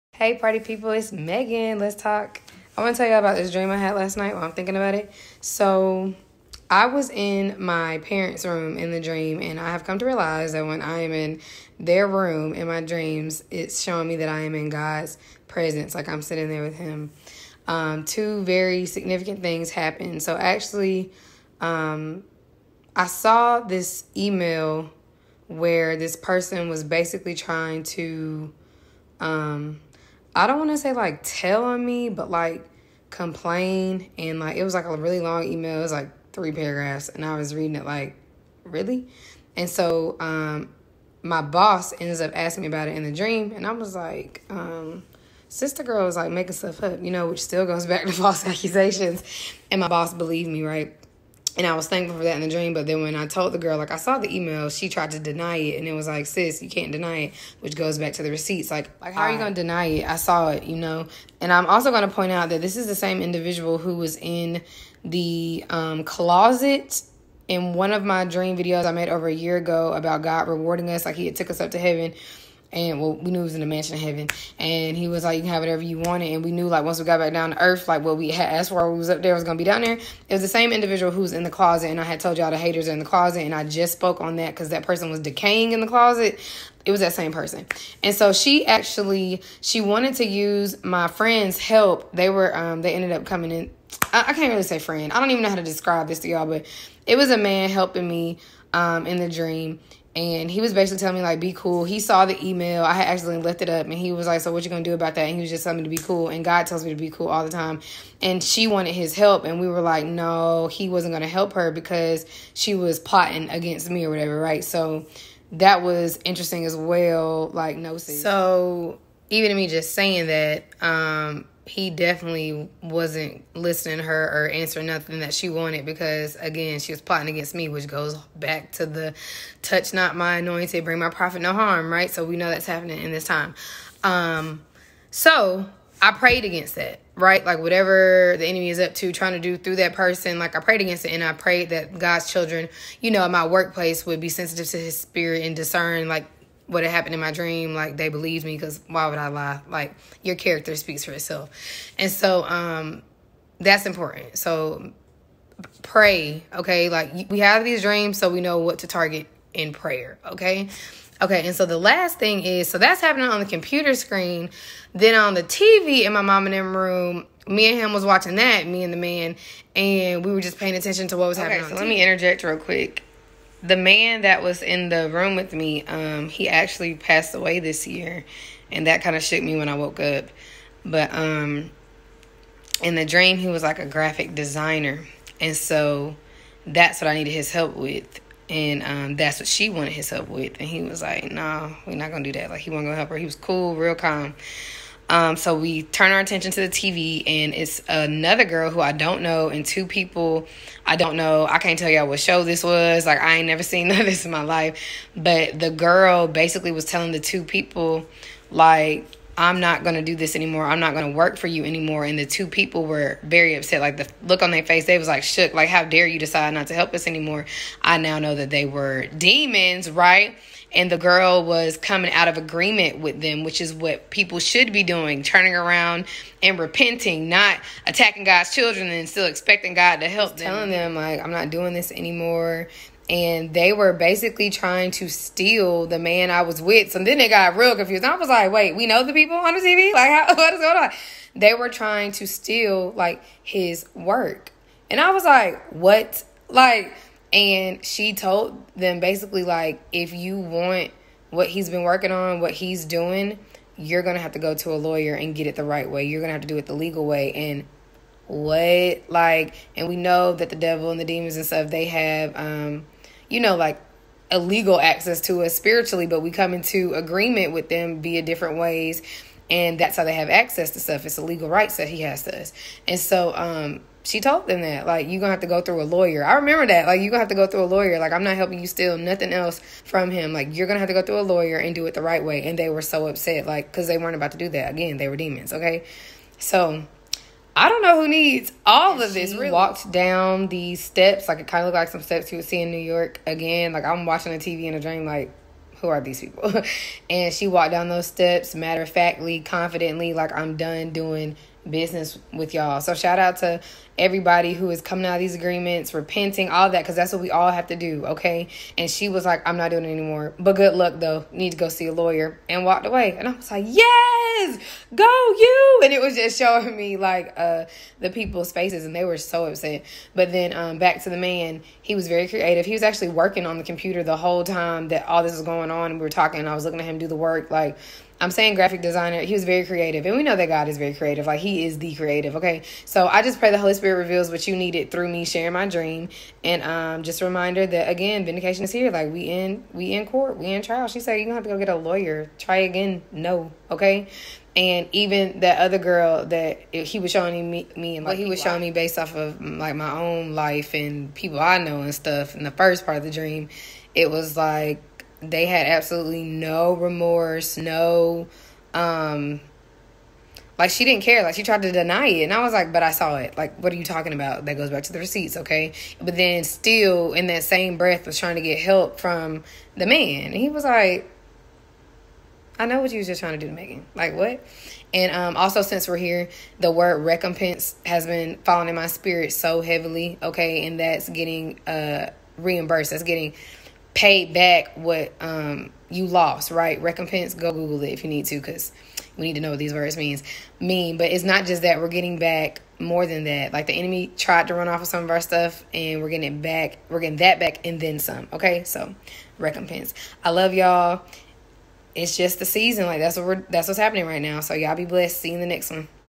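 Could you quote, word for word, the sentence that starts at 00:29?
Um, I don't want to say like tell on me, but like complain.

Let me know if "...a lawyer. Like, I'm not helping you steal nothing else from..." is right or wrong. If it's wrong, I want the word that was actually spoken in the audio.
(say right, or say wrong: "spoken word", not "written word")
right.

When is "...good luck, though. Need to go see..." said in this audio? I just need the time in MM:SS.
05:10.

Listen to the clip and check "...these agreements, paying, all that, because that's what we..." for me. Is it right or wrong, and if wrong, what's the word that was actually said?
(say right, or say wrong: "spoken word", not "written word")
wrong: "repenting", not "paying".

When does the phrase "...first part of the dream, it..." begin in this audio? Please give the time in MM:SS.
05:52.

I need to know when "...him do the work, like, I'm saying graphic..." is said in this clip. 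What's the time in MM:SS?
05:26.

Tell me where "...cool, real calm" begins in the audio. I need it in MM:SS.
03:13.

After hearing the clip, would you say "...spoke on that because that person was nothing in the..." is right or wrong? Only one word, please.
wrong.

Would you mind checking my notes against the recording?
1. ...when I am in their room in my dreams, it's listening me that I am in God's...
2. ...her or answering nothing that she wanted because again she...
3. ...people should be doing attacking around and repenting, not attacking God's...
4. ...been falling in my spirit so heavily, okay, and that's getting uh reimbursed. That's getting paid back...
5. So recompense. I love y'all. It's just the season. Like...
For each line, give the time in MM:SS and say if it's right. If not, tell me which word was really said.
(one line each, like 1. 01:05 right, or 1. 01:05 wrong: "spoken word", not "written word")
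1. 00:10 wrong: "showing", not "listening"
2. 02:04 right
3. 03:44 wrong: "turning", not "attacking"
4. 06:18 right
5. 06:38 right.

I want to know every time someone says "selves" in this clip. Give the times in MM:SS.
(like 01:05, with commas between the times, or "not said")
not said.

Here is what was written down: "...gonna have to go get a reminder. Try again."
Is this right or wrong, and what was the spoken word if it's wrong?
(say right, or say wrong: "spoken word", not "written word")
wrong: "lawyer", not "reminder".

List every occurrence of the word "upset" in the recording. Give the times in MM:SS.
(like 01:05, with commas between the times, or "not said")
03:33, 04:43, 05:19.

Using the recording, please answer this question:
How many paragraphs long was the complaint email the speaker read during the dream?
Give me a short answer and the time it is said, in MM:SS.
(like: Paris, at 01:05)
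3, at 00:36.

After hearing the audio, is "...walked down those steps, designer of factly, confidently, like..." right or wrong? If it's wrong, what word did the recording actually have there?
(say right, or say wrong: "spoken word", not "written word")
wrong: "matter", not "designer".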